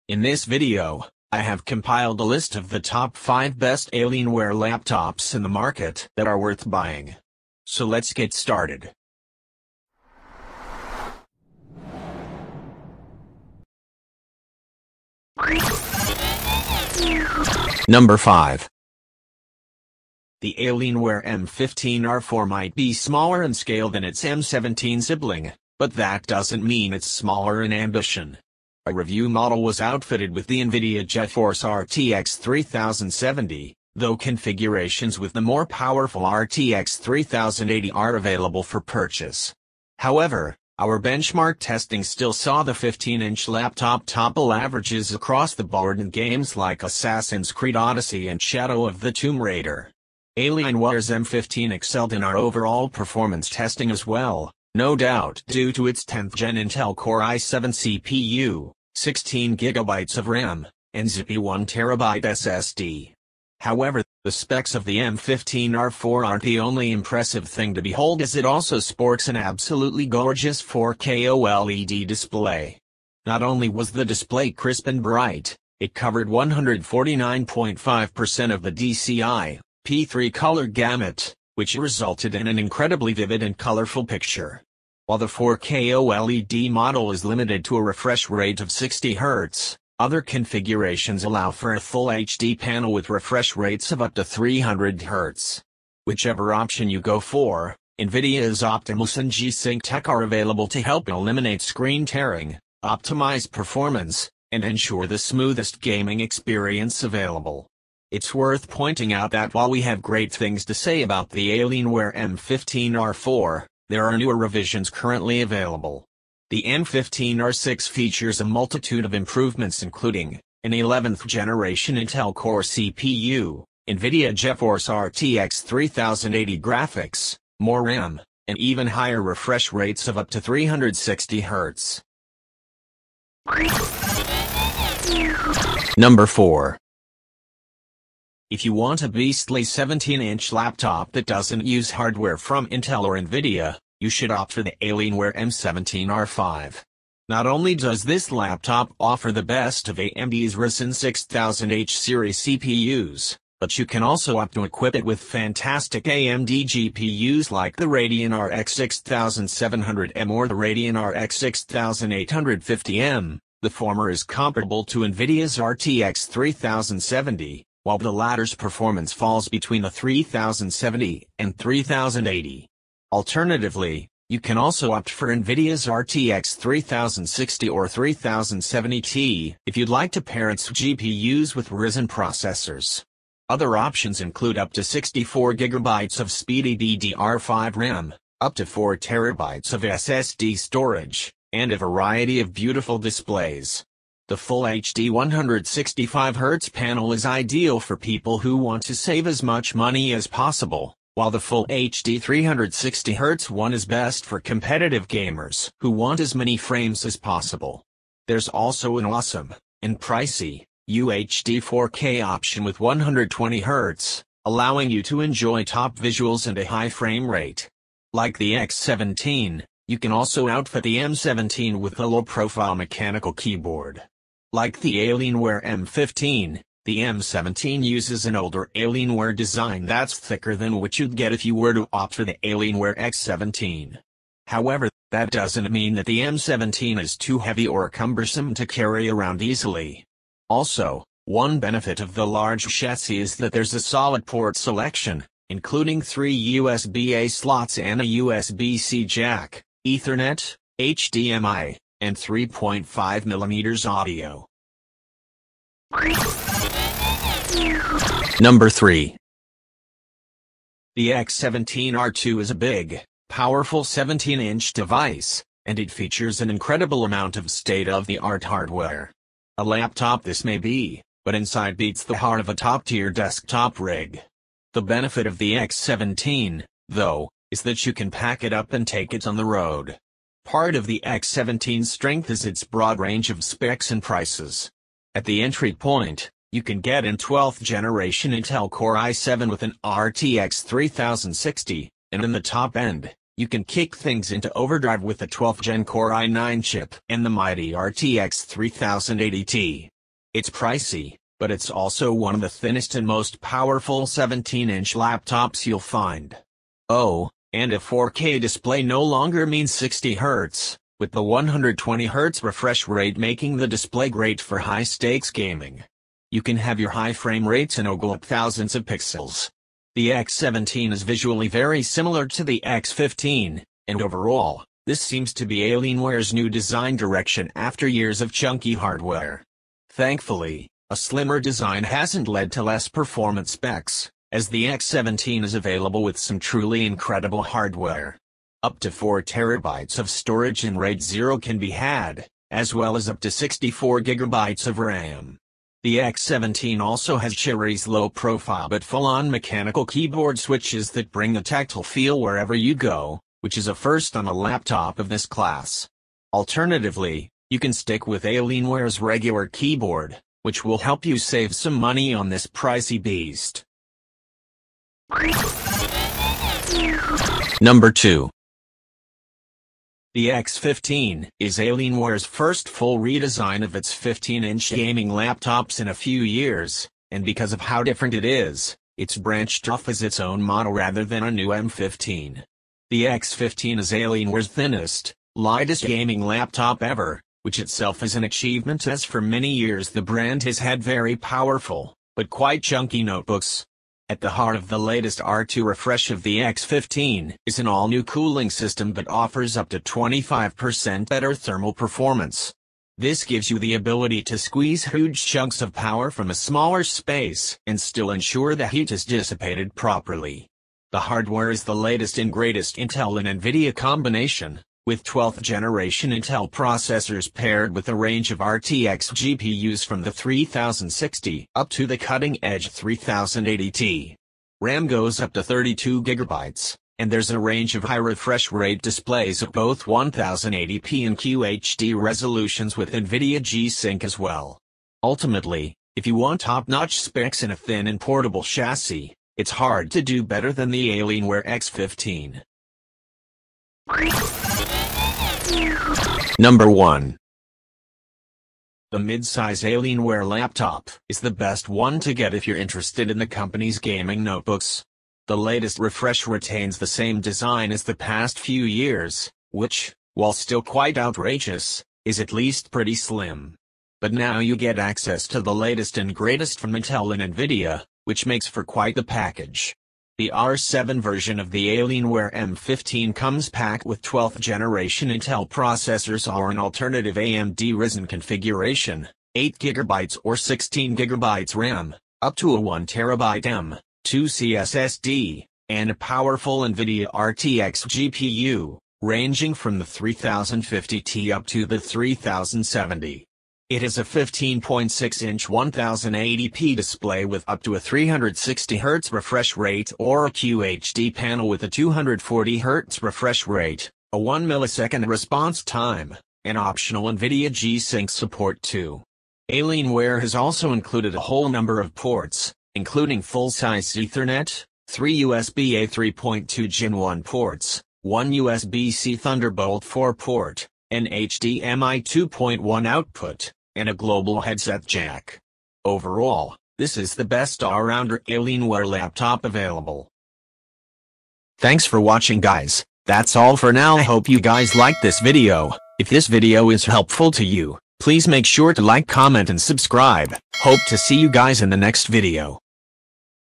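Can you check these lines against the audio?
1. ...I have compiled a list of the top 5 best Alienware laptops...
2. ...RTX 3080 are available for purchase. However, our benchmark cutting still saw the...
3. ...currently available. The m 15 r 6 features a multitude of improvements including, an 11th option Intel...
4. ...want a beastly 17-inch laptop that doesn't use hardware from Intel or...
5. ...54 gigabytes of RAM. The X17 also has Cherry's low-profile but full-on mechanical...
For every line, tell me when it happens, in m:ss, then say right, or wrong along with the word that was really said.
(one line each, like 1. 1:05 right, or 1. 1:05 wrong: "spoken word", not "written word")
1. 0:01 right
2. 0:36 wrong: "testing", not "cutting"
3. 1:54 wrong: "generation", not "option"
4. 2:18 right
5. 5:43 wrong: "64", not "54".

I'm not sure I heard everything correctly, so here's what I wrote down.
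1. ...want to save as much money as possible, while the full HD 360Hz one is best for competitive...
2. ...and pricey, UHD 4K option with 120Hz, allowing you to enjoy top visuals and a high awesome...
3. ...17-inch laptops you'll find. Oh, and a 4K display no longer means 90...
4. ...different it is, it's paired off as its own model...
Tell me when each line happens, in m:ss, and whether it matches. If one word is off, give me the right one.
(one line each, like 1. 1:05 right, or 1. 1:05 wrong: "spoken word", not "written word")
1. 3:18 right
2. 3:29 wrong: "frame", not "awesome"
3. 5:04 wrong: "60", not "90"
4. 6:17 wrong: "branched", not "paired".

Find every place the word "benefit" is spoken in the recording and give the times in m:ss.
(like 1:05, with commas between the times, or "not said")
4:01, 4:34.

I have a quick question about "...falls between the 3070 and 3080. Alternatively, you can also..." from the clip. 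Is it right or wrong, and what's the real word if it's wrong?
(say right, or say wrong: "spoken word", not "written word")
right.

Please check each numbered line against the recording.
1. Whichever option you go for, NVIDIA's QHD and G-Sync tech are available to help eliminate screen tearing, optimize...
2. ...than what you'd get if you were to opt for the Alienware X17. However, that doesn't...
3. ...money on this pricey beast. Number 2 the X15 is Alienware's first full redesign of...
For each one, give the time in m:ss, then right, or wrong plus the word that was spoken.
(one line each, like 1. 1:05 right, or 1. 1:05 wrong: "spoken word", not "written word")
1. 1:36 wrong: "Optimus", not "QHD"
2. 3:50 right
3. 6:01 right.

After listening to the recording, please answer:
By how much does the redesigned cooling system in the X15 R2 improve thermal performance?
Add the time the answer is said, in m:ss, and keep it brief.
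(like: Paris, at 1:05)
Up to 25%, at 6:39.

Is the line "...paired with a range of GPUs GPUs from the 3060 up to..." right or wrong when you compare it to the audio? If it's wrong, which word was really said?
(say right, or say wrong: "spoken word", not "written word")
wrong: "RTX", not "GPUs".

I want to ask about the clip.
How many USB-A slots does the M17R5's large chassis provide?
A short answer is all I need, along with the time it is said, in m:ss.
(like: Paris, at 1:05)
3, at 4:06.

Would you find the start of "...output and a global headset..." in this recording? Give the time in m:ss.
8:42.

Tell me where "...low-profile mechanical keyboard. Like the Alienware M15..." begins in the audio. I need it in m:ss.
3:42.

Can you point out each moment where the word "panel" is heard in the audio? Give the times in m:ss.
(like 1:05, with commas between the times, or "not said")
1:32, 3:16, 8:21.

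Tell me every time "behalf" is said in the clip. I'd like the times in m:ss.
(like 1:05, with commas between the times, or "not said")
not said.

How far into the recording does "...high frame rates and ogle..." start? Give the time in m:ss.
5:16.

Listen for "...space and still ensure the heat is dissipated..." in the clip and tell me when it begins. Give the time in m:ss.
6:46.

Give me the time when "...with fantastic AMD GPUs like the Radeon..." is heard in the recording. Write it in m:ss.
2:35.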